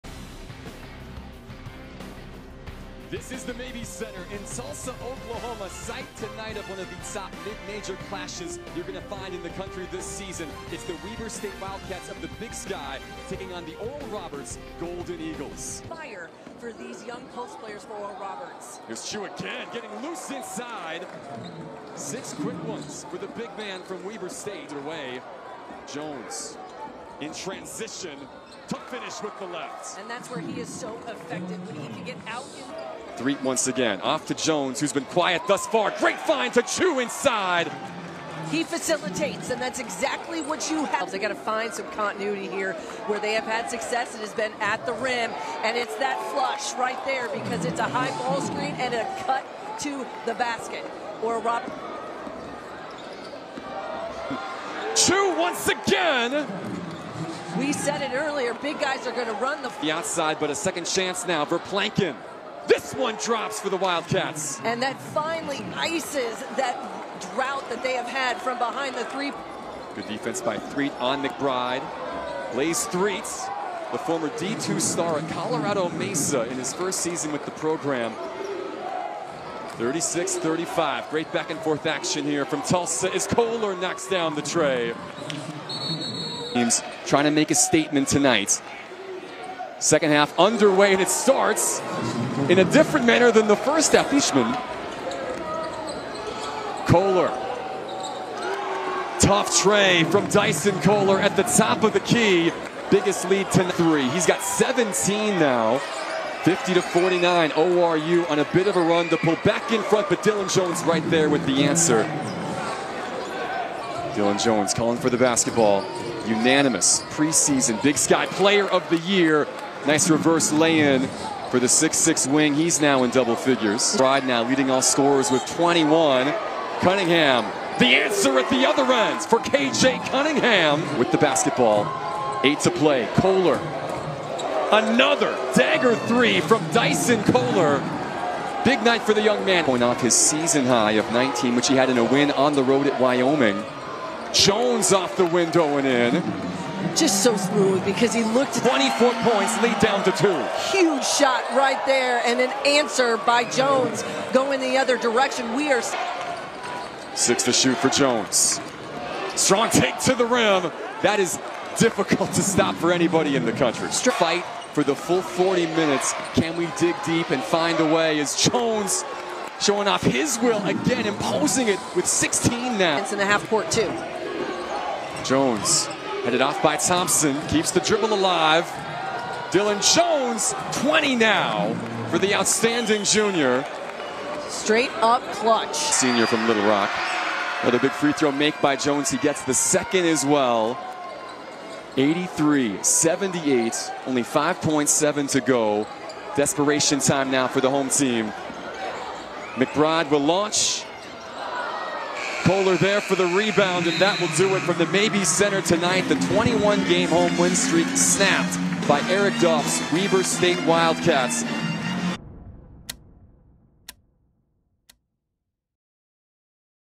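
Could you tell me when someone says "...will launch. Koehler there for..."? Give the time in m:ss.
3:20.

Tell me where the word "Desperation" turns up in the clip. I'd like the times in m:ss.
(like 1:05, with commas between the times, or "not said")
3:16.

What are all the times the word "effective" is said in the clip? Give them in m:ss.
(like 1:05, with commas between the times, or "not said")
0:31.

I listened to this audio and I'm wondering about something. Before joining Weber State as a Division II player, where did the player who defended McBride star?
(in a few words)
Colorado Mesa.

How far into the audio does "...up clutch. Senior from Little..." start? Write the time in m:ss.
3:04.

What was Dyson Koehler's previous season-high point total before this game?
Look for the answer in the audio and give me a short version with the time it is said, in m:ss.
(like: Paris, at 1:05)
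19, at 2:21.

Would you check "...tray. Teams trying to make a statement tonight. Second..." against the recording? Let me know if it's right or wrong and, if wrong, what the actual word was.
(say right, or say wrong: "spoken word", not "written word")
right.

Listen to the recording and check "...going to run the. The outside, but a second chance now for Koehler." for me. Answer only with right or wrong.
wrong.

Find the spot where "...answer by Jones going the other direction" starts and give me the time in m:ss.
2:32.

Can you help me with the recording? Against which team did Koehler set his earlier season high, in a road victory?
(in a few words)
Wyoming.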